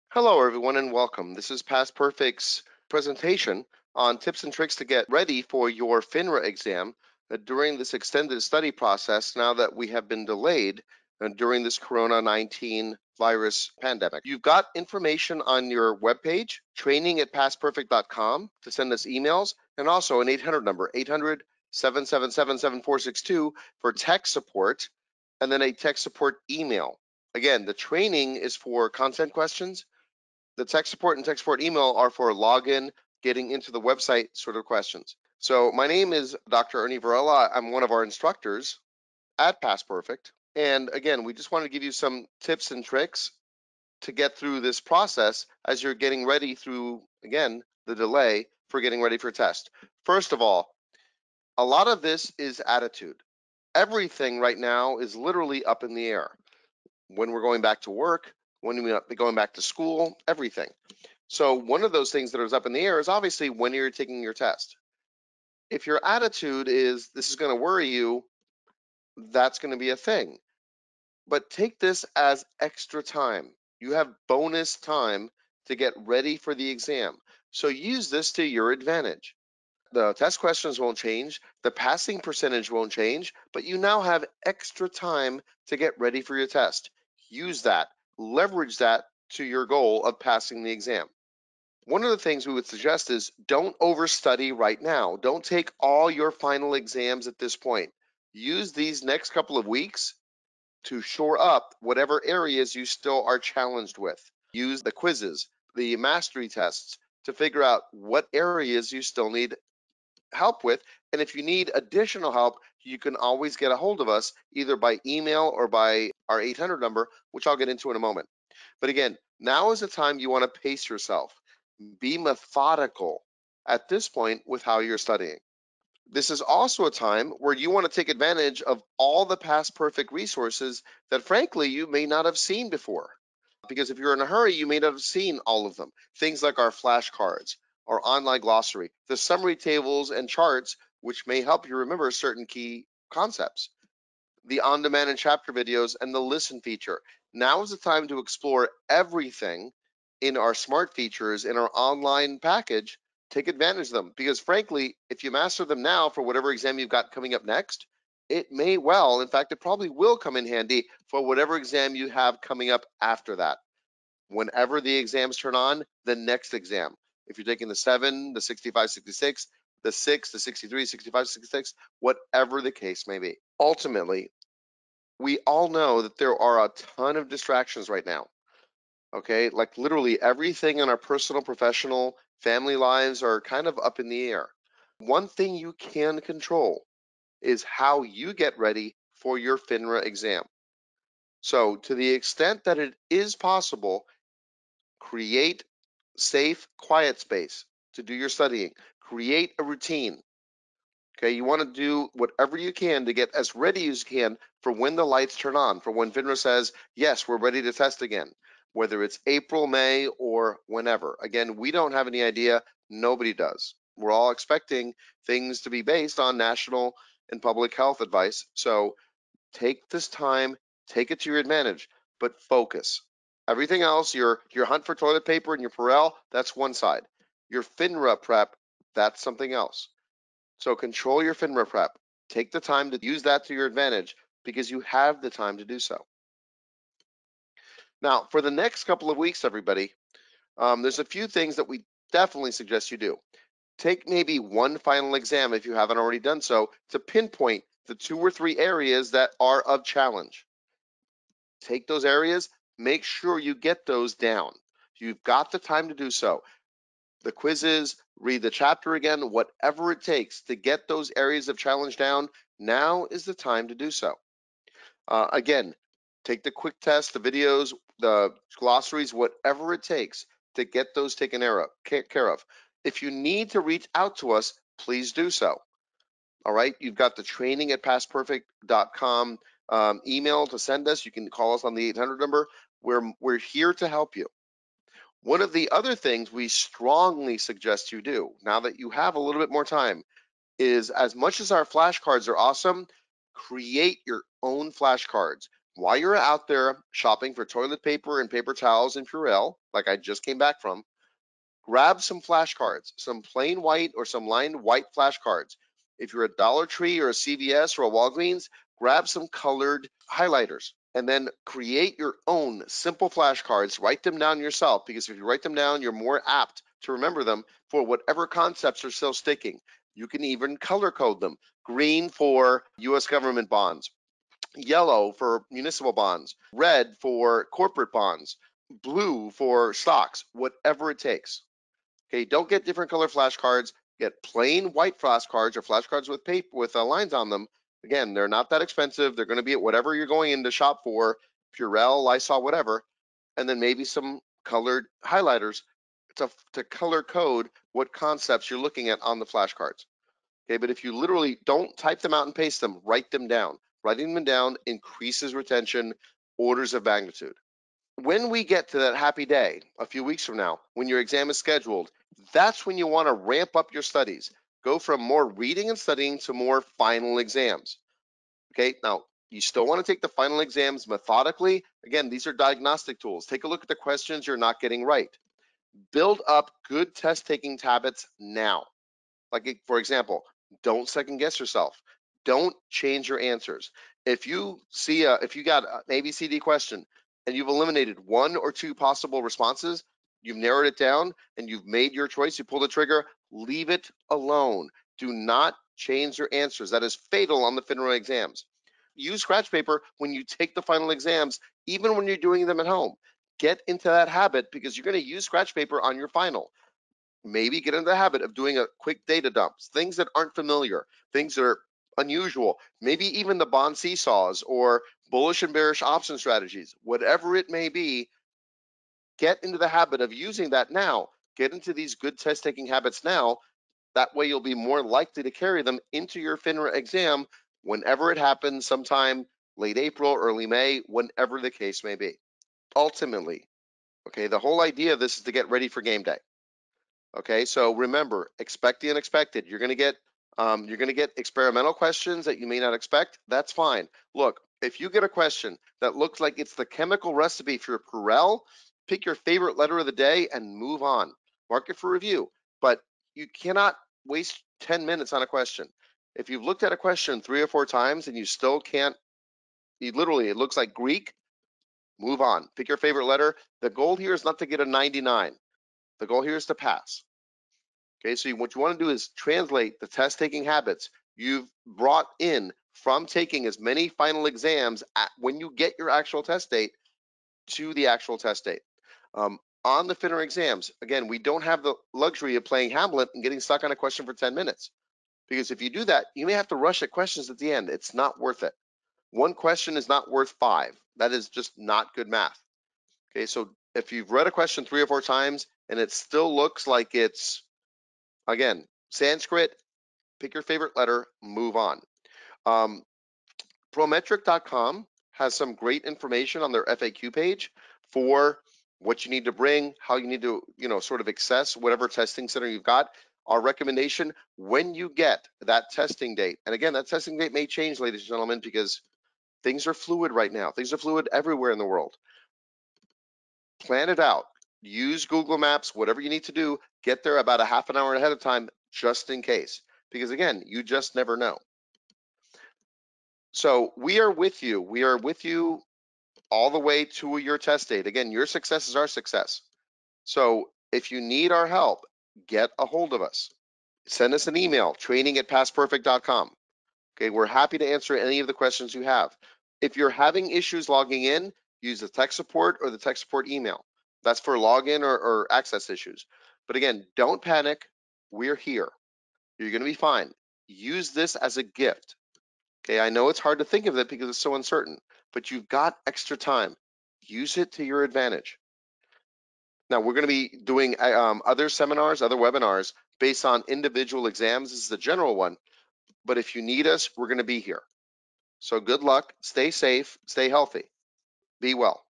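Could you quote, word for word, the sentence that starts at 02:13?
Because if you're in a hurry, you may not have seen all of them.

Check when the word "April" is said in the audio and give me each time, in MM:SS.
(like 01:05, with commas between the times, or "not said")
03:29, 07:09.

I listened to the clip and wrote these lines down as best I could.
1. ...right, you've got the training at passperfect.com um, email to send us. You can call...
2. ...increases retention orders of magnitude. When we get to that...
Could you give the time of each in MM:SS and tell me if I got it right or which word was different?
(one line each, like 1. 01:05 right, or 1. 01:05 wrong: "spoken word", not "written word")
1. 04:36 right
2. 05:54 right.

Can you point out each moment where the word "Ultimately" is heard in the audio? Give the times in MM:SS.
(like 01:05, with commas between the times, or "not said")
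02:53, 07:12.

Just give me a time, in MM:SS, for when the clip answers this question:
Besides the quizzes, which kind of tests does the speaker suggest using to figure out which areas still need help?
01:45.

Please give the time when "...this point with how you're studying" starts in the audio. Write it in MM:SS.
02:03.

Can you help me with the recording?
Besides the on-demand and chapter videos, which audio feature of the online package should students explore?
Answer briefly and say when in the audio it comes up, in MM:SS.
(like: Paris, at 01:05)
listen feature, at 02:26.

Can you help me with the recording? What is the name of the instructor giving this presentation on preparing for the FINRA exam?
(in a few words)
Dr. Ernie Varela.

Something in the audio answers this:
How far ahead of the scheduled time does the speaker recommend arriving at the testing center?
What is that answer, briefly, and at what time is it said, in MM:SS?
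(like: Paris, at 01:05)
half an hour, at 08:47.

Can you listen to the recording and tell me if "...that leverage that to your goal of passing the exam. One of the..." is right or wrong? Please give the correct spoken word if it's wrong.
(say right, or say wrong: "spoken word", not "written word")
right.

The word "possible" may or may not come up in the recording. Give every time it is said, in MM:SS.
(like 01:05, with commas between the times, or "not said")
03:13, 06:28.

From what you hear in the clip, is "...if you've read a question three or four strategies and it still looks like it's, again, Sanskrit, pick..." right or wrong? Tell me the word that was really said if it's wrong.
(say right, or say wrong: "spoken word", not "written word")
wrong: "times", not "strategies".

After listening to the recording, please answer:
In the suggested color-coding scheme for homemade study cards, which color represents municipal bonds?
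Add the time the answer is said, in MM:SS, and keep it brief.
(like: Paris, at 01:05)
yellow, at 05:24.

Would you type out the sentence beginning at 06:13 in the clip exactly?
Take a look at the questions you're not getting right.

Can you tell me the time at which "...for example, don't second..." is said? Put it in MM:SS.
06:19.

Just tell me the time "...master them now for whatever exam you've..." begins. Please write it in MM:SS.
02:35.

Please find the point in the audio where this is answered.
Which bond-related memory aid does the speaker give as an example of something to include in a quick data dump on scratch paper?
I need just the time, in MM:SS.
06:53.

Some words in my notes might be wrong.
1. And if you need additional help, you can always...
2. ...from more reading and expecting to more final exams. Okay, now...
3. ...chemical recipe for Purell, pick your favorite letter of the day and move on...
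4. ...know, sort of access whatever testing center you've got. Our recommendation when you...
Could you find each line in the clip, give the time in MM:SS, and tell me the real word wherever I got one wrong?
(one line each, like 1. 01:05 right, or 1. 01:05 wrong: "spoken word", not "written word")
1. 01:51 right
2. 06:04 wrong: "studying", not "expecting"
3. 07:26 right
4. 08:30 right.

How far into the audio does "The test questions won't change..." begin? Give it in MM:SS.
01:19.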